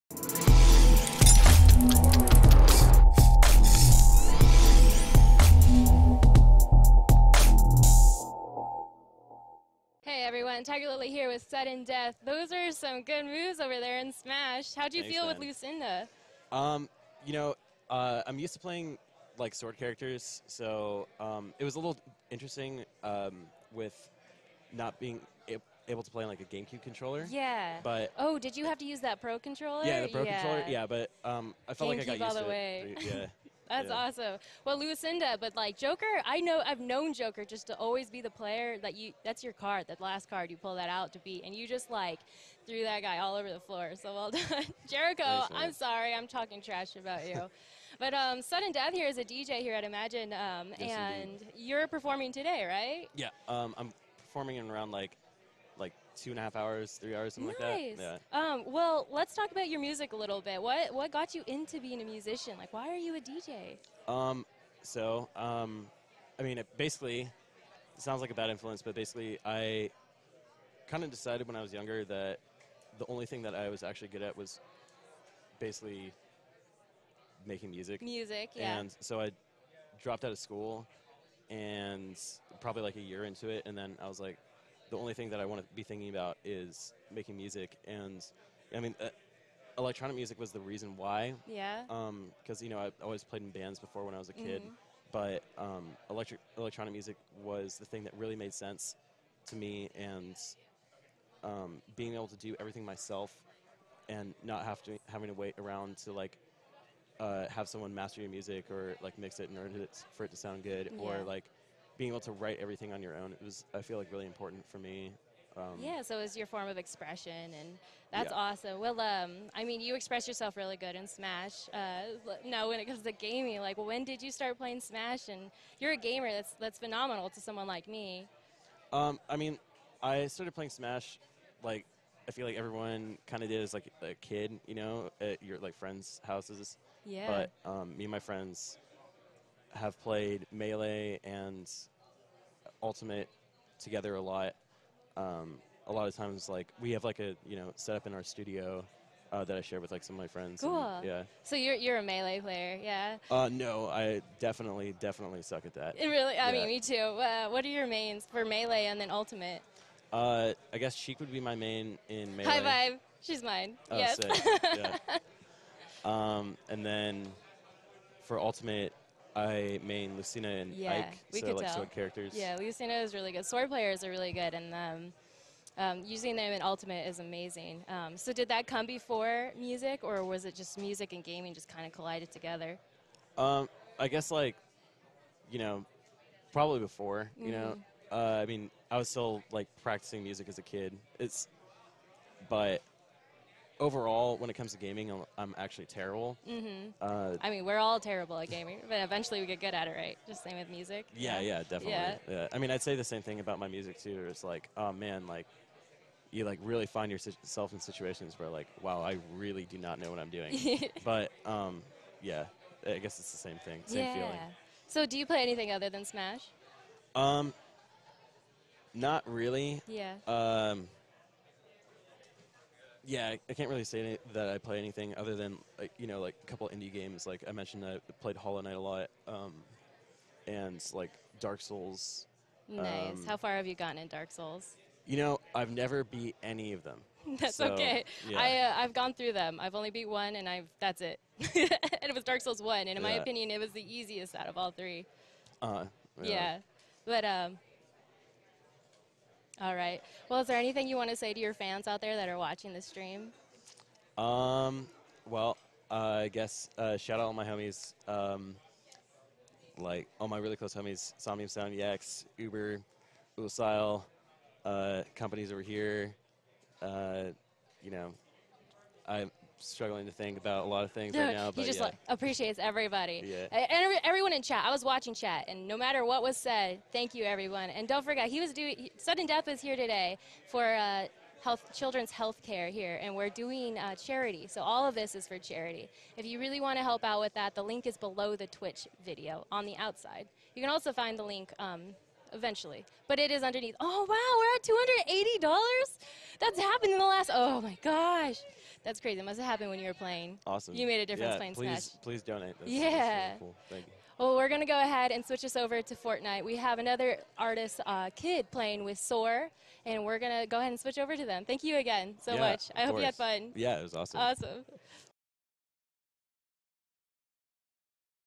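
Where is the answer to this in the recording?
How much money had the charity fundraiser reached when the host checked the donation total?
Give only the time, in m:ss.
4:55.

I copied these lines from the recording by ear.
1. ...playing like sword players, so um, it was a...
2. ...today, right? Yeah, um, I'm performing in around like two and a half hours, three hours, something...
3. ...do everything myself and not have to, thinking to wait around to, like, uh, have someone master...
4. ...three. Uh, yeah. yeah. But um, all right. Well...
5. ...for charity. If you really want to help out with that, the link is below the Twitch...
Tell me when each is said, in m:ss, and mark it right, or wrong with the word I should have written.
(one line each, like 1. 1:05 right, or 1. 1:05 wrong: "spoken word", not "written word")
1. 0:18 wrong: "characters", not "players"
2. 0:52 right
3. 1:42 wrong: "having", not "thinking"
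4. 4:04 right
5. 4:45 right.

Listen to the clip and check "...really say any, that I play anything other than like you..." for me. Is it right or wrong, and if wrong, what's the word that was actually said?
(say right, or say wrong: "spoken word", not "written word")
right.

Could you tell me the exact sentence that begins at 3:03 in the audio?
Um, I guess like, you know, probably before.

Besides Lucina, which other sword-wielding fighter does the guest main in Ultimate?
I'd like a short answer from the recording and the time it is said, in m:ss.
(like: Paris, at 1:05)
Ike, at 2:51.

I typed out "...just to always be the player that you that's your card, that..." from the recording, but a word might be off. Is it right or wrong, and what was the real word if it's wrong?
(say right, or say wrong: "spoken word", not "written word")
right.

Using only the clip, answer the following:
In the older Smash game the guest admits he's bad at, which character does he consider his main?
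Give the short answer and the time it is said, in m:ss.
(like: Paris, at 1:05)
Sheik, at 2:40.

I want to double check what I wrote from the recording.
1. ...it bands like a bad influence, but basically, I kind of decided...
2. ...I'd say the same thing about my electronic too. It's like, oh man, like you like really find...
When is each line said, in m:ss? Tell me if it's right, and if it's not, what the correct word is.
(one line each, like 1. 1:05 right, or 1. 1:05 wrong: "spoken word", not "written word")
1. 1:07 wrong: "sounds", not "bands"
2. 3:22 wrong: "music", not "electronic".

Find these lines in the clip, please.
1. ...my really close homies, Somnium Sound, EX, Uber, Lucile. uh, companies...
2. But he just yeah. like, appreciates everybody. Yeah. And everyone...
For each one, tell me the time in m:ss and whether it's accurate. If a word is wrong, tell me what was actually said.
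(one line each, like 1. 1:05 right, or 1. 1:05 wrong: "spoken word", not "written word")
1. 4:20 right
2. 4:31 right.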